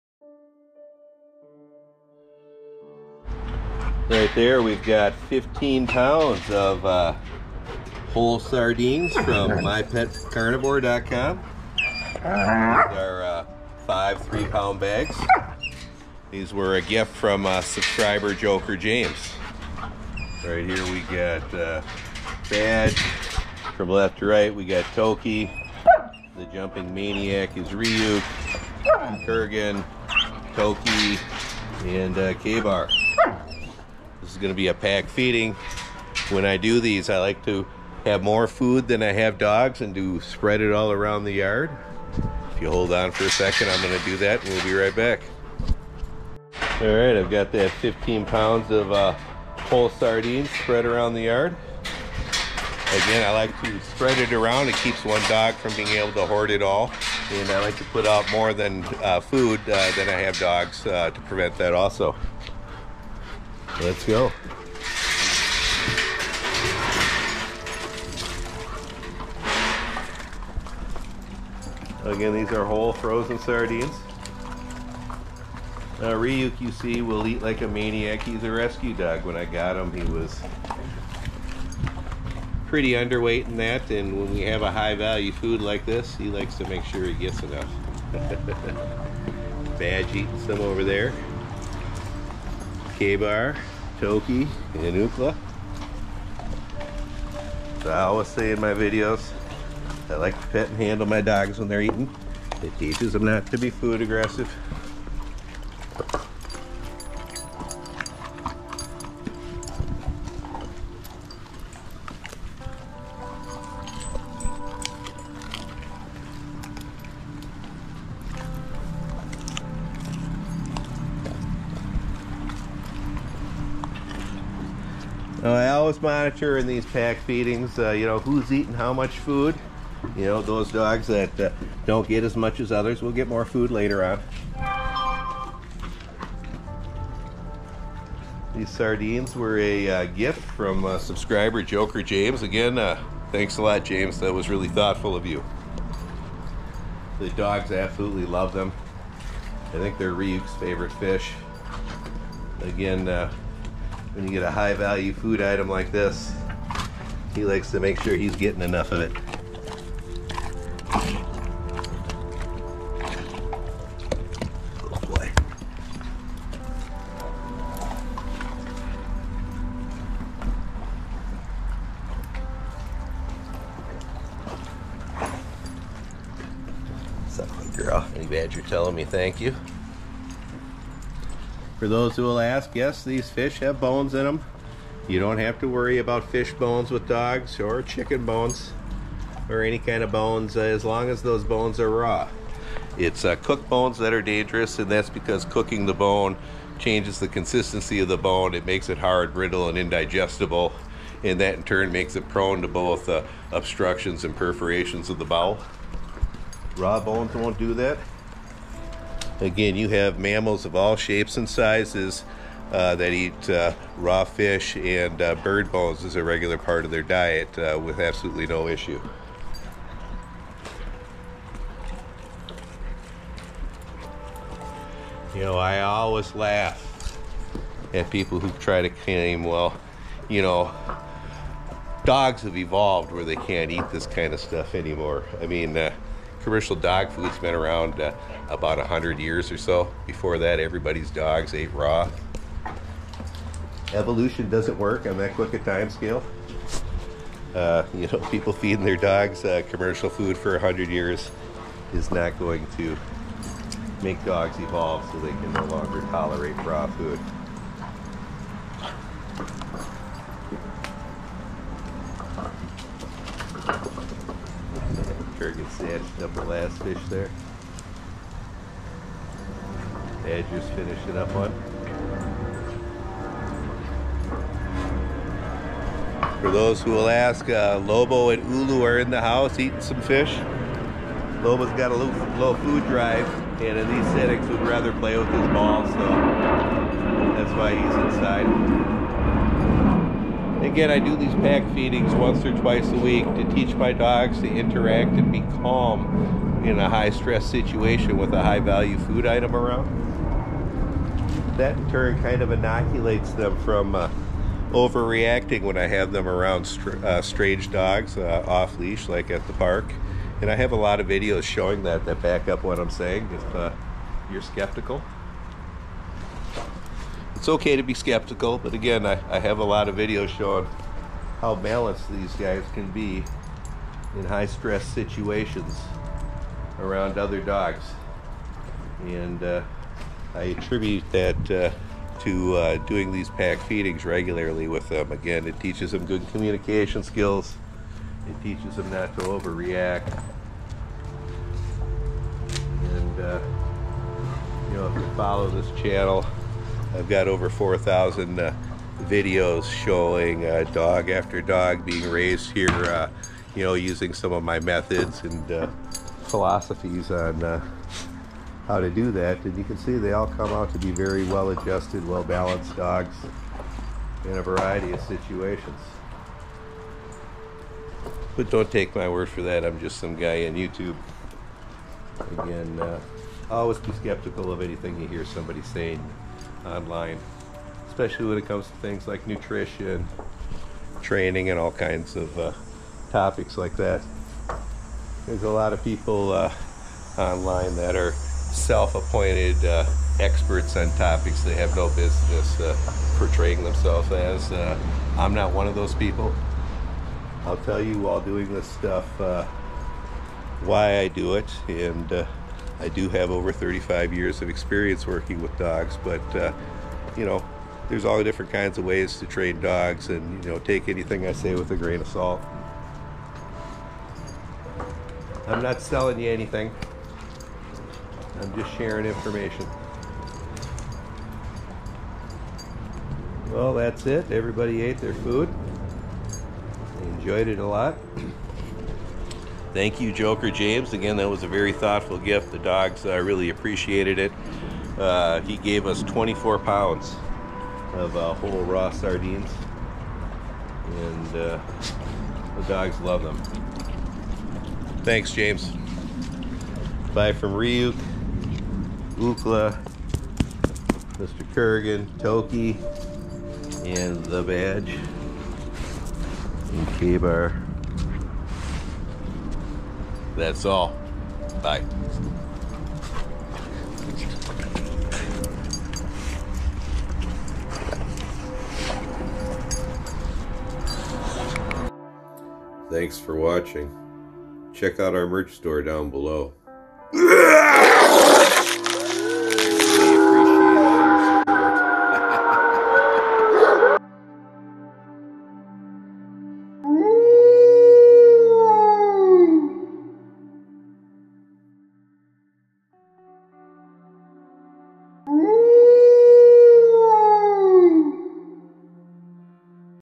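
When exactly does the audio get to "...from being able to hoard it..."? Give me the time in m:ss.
0:55.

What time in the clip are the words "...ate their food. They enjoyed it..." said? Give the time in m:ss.
7:04.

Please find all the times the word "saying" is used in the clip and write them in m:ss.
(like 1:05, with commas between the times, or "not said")
5:12, 6:15.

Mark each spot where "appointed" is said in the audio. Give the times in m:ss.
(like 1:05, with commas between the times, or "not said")
6:28.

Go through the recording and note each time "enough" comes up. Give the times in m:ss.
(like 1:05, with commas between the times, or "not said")
1:27, 2:38.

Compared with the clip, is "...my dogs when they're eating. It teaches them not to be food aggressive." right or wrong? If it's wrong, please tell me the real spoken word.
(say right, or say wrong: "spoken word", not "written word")
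right.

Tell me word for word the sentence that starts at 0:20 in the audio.
Right here, we got uh, Badge from left to right.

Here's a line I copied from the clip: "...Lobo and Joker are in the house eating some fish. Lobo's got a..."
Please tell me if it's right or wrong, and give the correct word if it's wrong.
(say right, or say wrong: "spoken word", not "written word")
wrong: "Ulu", not "Joker".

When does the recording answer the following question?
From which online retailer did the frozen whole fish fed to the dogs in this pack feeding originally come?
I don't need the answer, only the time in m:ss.
0:09.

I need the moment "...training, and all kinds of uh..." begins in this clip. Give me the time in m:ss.
6:21.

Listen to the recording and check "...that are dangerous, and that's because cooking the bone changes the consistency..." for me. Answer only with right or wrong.
right.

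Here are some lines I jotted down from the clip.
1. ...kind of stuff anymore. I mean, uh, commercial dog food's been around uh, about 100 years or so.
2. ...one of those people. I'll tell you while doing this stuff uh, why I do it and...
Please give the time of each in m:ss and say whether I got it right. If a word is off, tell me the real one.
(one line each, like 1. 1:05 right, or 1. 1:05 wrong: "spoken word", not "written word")
1. 3:54 right
2. 6:35 right.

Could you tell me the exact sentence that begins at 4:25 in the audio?
edged up the last fish there.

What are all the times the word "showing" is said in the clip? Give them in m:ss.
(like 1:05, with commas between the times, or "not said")
5:11, 5:20, 5:49.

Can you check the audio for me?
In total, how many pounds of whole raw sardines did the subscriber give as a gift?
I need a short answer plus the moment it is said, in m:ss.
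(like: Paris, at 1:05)
24 pounds, at 7:16.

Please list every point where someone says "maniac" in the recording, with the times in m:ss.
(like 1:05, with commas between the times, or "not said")
0:26, 1:17.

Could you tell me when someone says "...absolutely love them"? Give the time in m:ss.
2:27.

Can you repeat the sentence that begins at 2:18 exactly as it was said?
These sardines were a uh, gift from uh, subscriber Joker James.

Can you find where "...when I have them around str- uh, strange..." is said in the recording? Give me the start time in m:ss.
5:05.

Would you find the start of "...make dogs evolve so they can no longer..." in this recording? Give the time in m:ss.
4:14.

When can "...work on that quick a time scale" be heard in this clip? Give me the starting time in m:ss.
4:04.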